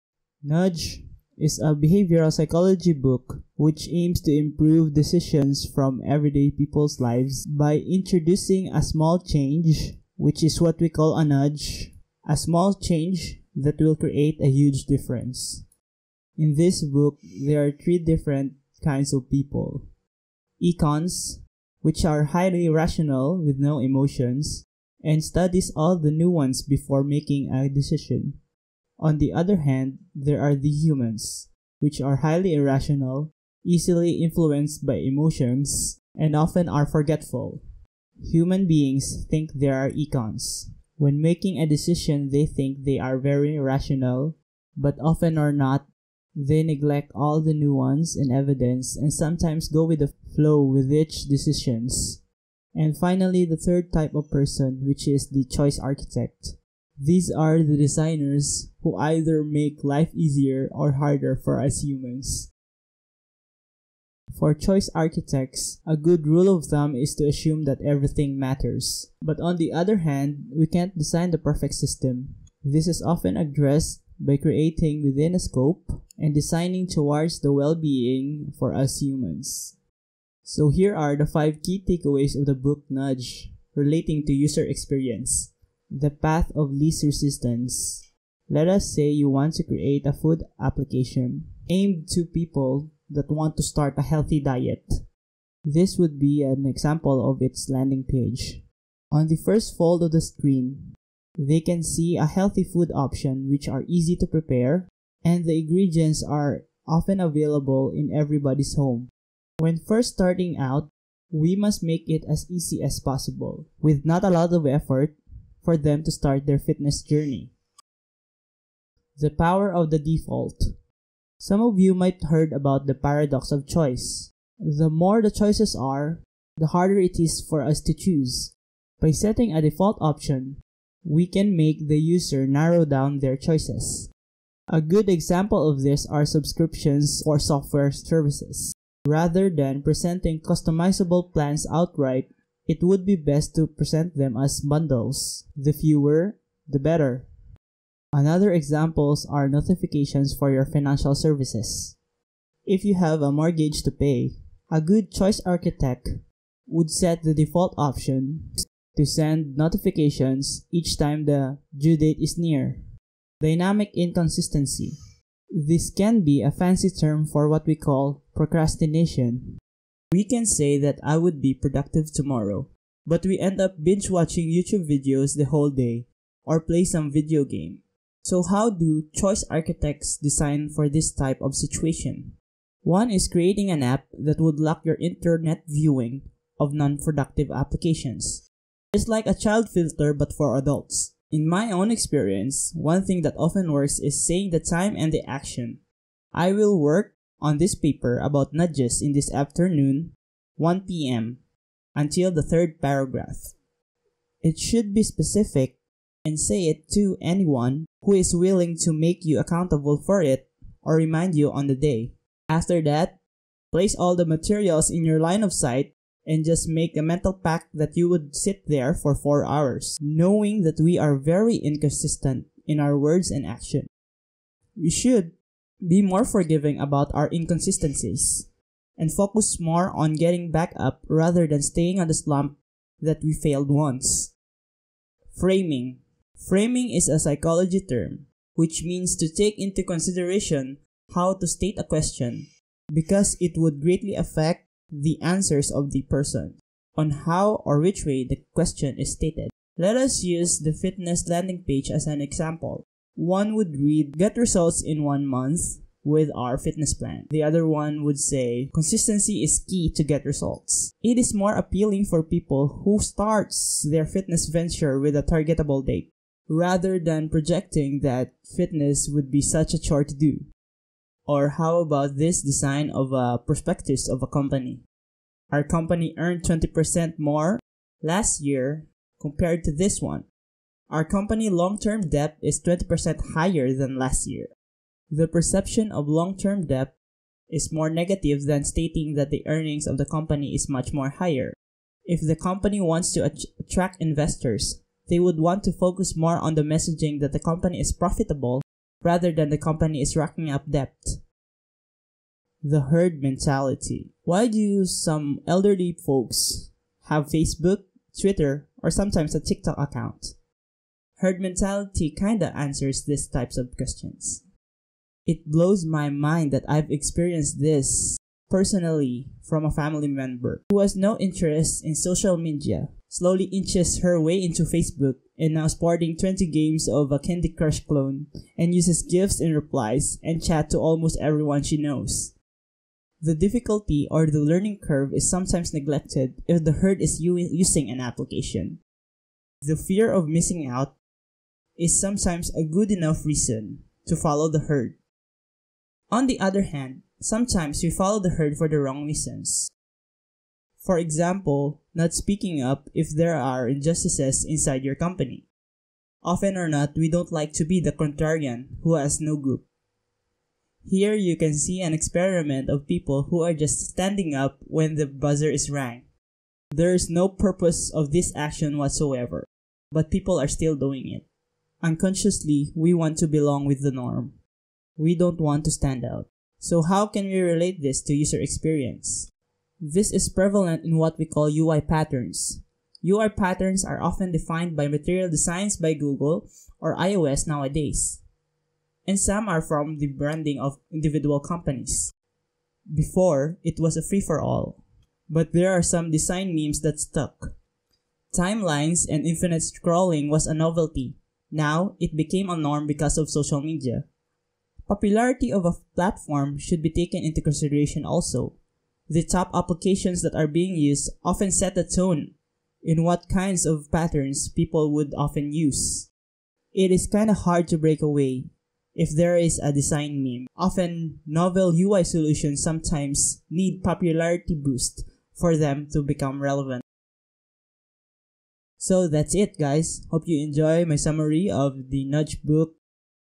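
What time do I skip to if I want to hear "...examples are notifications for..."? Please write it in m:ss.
2:28.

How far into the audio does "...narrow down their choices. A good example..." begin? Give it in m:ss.
2:12.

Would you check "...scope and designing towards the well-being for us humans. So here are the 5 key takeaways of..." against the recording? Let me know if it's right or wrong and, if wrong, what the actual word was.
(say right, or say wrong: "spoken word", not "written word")
right.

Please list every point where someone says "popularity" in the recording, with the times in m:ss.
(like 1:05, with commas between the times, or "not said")
6:44, 7:03.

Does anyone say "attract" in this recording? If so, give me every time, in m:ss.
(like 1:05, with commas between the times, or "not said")
4:53.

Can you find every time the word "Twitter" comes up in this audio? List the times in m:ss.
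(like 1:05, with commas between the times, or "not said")
5:08.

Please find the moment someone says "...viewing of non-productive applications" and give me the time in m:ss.
3:05.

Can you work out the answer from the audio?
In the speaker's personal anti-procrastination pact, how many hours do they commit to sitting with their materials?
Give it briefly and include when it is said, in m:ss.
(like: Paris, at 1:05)
4, at 3:39.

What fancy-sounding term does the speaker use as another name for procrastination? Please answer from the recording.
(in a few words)
Dynamic inconsistency.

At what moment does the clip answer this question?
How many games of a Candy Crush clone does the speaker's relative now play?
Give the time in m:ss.
5:26.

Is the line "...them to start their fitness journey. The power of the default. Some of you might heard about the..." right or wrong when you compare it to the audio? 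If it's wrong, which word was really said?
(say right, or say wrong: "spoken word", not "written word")
right.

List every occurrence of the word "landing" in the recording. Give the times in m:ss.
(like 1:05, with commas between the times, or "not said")
1:37, 4:11.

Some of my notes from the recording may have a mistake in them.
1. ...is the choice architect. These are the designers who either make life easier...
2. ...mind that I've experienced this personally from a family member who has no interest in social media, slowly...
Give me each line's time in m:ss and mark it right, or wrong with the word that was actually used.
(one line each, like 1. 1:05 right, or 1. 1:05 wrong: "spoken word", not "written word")
1. 0:55 right
2. 5:16 right.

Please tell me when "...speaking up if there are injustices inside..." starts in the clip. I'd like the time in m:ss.
5:52.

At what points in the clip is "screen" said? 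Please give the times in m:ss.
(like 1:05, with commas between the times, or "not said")
1:40.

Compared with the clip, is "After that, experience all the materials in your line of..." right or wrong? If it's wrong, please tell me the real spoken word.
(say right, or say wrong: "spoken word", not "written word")
wrong: "place", not "experience".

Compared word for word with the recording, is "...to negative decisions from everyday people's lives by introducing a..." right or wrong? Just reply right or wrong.
wrong.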